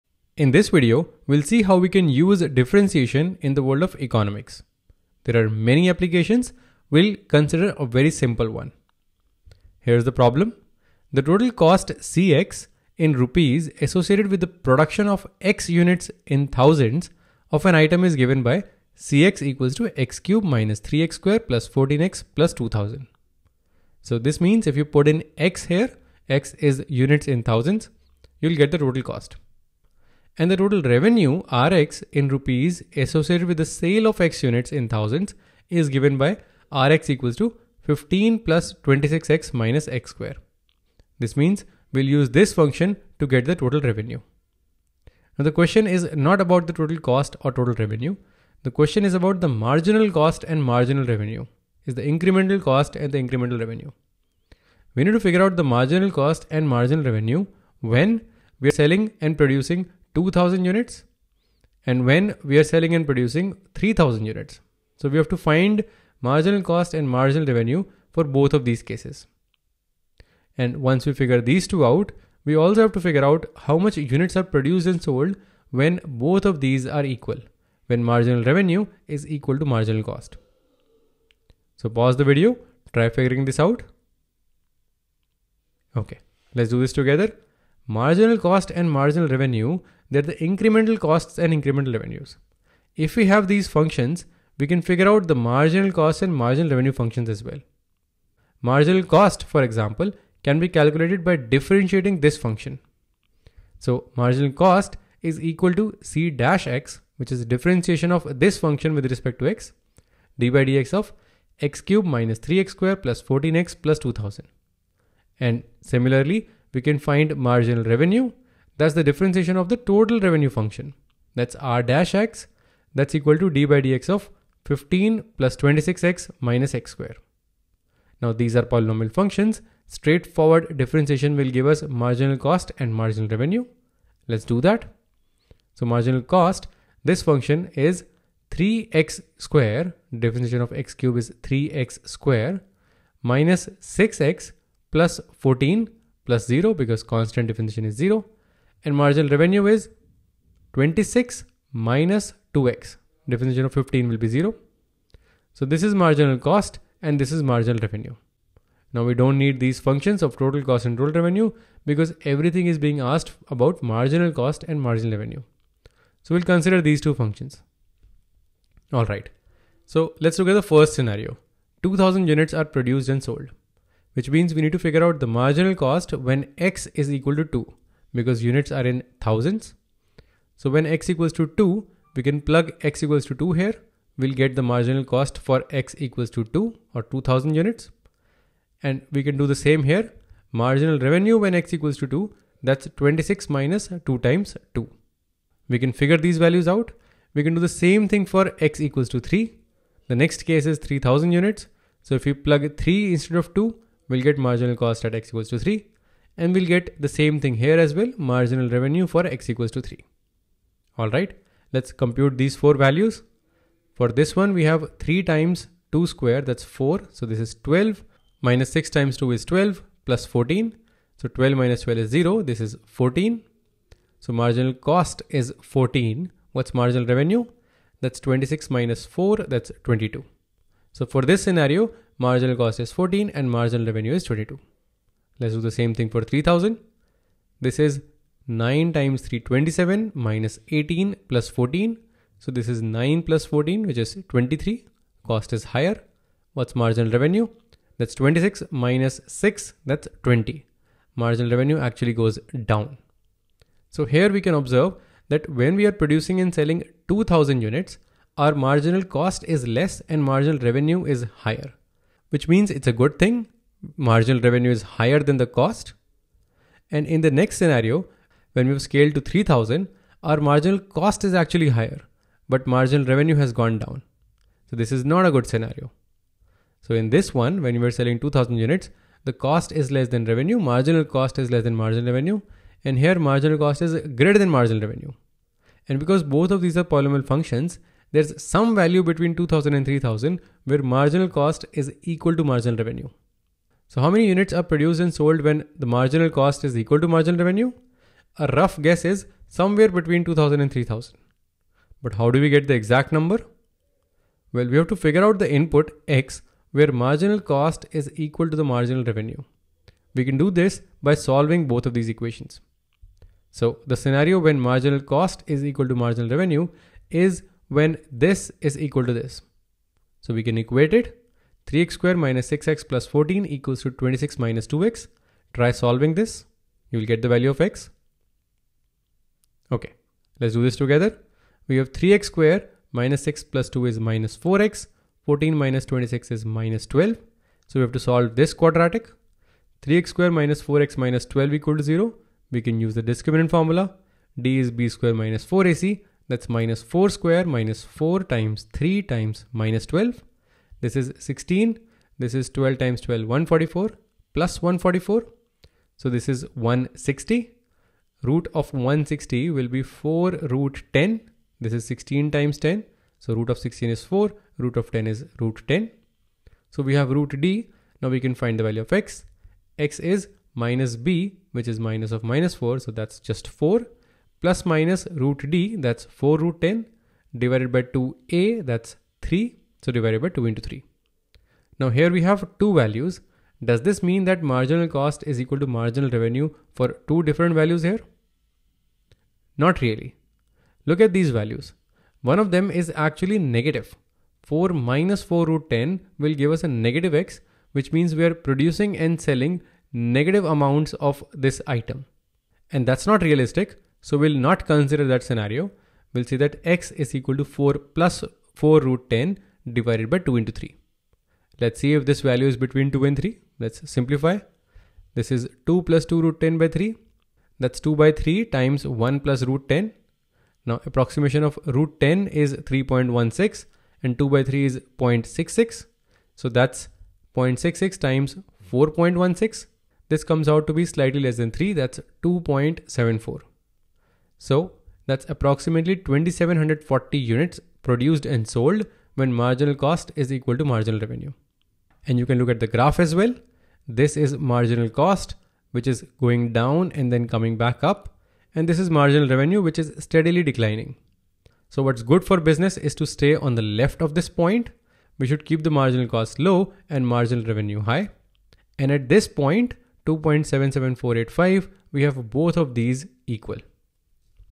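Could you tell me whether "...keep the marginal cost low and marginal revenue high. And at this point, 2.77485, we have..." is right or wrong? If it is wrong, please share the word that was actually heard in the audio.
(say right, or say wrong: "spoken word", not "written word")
right.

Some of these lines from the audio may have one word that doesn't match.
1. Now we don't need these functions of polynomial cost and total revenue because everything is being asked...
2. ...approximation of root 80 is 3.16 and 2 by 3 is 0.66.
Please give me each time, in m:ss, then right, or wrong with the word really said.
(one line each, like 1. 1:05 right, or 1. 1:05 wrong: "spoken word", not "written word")
1. 2:38 wrong: "total", not "polynomial"
2. 7:00 wrong: "10", not "80".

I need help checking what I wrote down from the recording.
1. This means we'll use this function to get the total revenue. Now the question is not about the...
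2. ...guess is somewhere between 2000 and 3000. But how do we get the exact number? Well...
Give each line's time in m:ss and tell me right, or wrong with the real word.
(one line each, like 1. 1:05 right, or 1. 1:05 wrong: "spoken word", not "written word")
1. 0:41 right
2. 4:58 right.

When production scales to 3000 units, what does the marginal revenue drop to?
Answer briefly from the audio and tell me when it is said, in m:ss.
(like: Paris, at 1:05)
20, at 4:09.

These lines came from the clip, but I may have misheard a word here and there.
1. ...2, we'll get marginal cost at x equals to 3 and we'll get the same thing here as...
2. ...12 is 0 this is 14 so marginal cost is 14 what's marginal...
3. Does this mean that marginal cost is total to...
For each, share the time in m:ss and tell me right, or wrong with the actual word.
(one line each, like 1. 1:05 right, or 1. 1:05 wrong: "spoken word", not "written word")
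1. 3:23 right
2. 3:41 right
3. 6:23 wrong: "equal", not "total".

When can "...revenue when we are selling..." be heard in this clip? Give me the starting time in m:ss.
0:57.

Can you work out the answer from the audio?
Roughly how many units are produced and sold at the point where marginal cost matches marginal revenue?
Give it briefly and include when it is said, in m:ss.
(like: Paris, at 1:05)
2740, at 7:15.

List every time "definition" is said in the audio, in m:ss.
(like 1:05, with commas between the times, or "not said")
2:20, 2:27, 2:33.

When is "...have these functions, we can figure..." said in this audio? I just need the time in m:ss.
1:33.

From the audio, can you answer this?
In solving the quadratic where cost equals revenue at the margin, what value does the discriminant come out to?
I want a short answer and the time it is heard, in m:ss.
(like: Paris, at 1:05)
160, at 5:56.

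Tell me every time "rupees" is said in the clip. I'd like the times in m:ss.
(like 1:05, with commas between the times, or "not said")
0:13, 0:32.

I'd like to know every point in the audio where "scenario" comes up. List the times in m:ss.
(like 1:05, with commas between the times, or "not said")
2:50, 3:51, 4:27, 4:35, 5:13, 6:45.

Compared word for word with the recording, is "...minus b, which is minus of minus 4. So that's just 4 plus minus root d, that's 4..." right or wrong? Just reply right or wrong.
right.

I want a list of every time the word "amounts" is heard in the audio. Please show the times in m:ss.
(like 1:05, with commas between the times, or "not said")
6:40.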